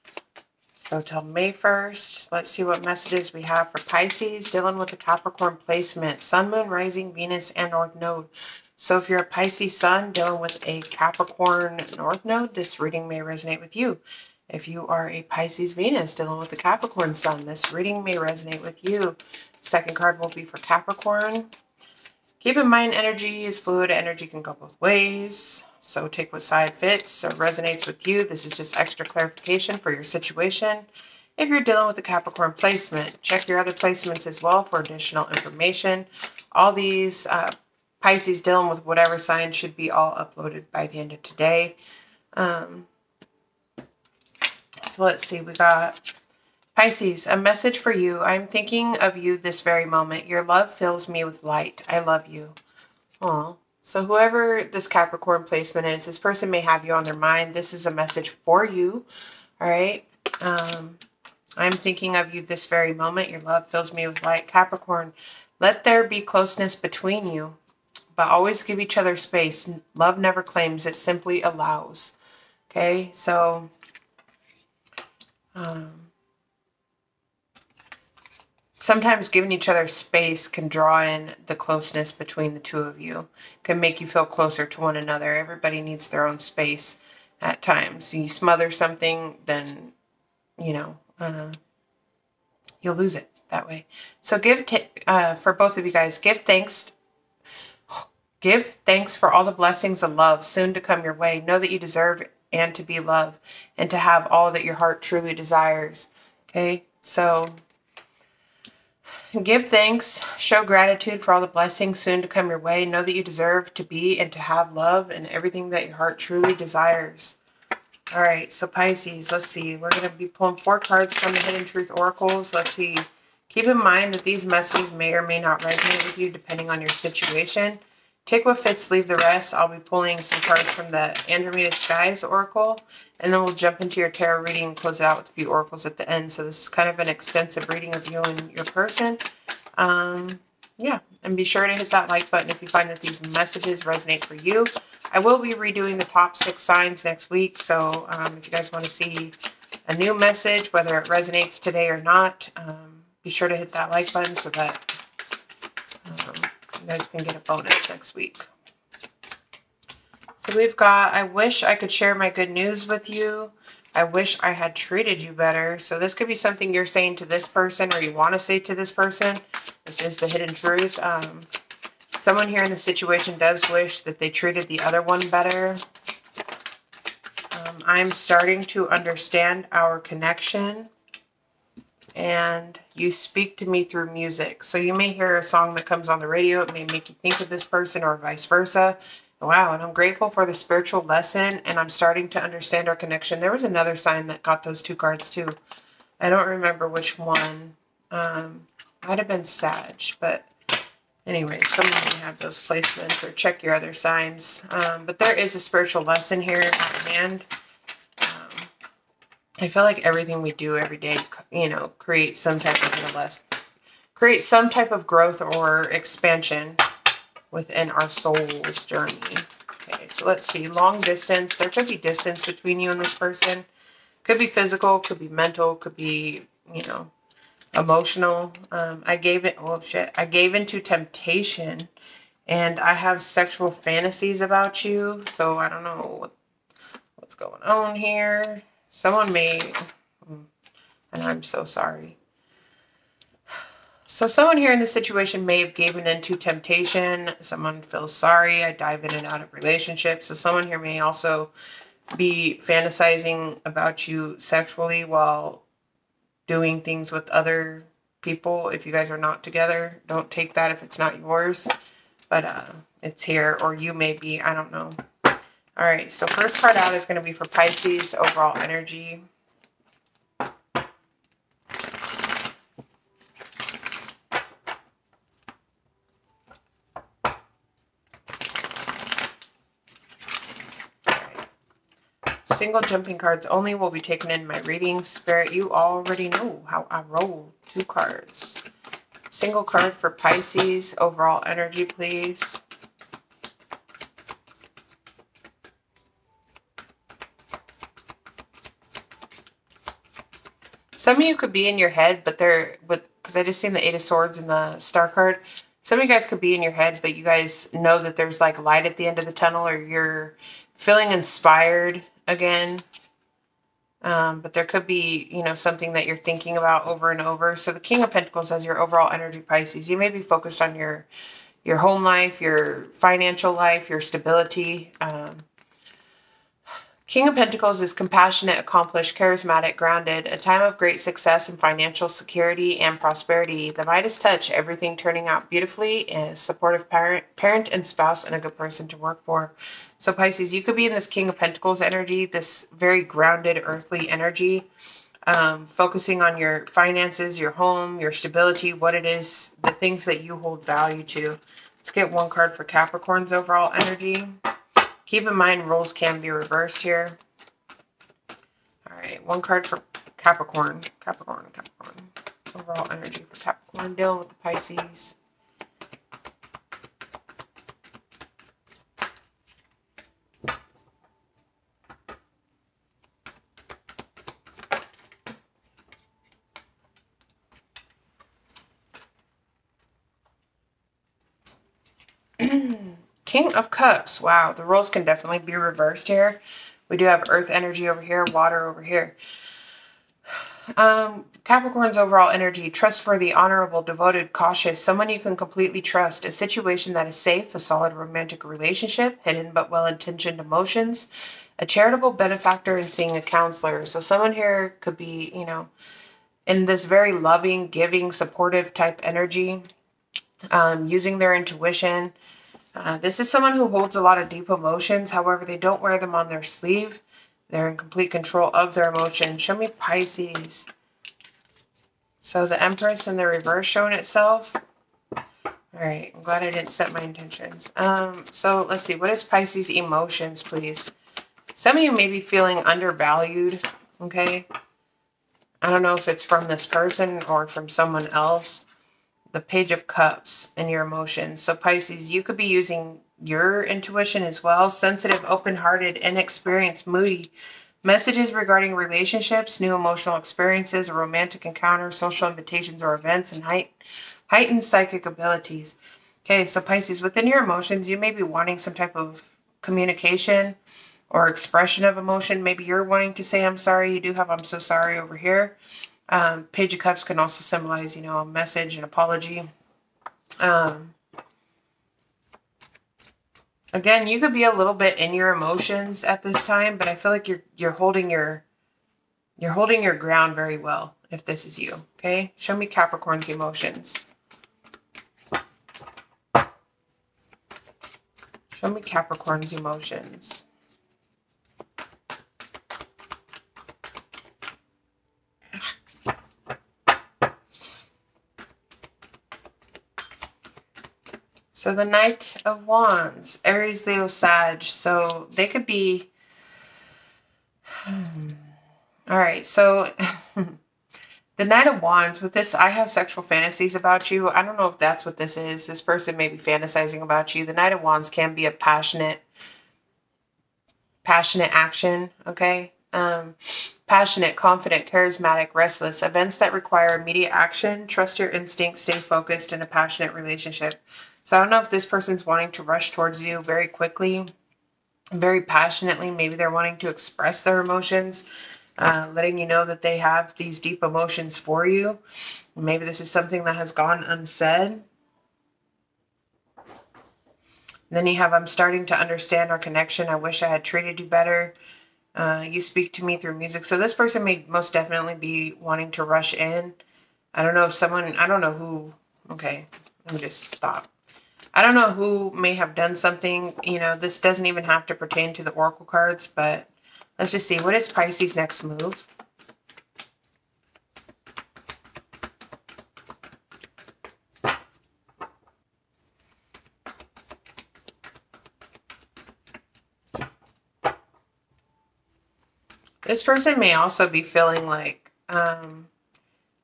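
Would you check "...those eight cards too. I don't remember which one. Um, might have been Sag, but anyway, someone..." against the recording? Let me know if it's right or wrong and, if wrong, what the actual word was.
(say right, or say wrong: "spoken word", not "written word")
wrong: "two", not "eight".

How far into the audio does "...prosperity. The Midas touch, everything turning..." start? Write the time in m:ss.
5:32.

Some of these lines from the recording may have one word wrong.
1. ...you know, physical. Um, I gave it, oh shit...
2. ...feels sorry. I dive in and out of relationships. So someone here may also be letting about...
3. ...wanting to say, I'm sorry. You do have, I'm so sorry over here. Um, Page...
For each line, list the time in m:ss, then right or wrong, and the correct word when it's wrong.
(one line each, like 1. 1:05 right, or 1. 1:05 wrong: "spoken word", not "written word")
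1. 3:46 wrong: "emotional", not "physical"
2. 4:07 wrong: "fantasizing", not "letting"
3. 7:42 right.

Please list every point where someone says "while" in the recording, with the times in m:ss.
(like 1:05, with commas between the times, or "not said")
4:15.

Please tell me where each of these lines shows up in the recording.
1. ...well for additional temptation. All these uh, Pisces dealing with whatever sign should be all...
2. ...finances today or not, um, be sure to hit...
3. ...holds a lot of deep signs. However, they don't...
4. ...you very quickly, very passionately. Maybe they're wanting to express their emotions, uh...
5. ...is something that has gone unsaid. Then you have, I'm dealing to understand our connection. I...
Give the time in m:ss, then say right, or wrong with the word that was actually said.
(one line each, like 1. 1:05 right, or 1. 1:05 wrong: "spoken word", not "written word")
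1. 0:34 wrong: "information", not "temptation"
2. 2:31 wrong: "resonates", not "finances"
3. 6:53 wrong: "emotions", not "signs"
4. 8:53 right
5. 9:03 wrong: "starting", not "dealing".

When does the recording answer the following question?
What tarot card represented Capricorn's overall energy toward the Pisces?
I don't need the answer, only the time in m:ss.
6:23.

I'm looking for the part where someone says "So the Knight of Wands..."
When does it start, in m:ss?
8:21.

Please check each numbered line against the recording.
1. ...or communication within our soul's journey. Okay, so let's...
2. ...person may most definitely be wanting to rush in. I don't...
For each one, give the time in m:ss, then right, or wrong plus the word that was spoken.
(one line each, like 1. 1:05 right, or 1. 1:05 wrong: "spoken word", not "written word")
1. 3:35 wrong: "expansion", not "communication"
2. 9:13 right.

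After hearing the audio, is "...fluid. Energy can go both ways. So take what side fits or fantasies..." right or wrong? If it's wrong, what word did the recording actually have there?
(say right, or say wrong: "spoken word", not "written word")
wrong: "resonates", not "fantasies".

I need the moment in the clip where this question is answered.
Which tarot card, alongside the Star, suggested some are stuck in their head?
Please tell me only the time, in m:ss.
5:03.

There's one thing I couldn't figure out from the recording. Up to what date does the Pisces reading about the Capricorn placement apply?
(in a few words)
May 1st.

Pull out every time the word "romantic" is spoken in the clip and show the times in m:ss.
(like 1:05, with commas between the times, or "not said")
6:37, 7:30.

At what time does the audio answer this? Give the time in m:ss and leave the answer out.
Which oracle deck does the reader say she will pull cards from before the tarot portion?
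2:11.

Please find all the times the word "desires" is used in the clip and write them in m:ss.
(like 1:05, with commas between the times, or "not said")
1:45, 1:56.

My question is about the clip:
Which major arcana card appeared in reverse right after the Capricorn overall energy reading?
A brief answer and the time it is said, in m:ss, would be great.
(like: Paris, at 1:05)
The Empress, at 7:02.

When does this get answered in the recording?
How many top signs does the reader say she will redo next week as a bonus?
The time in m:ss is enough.
2:26.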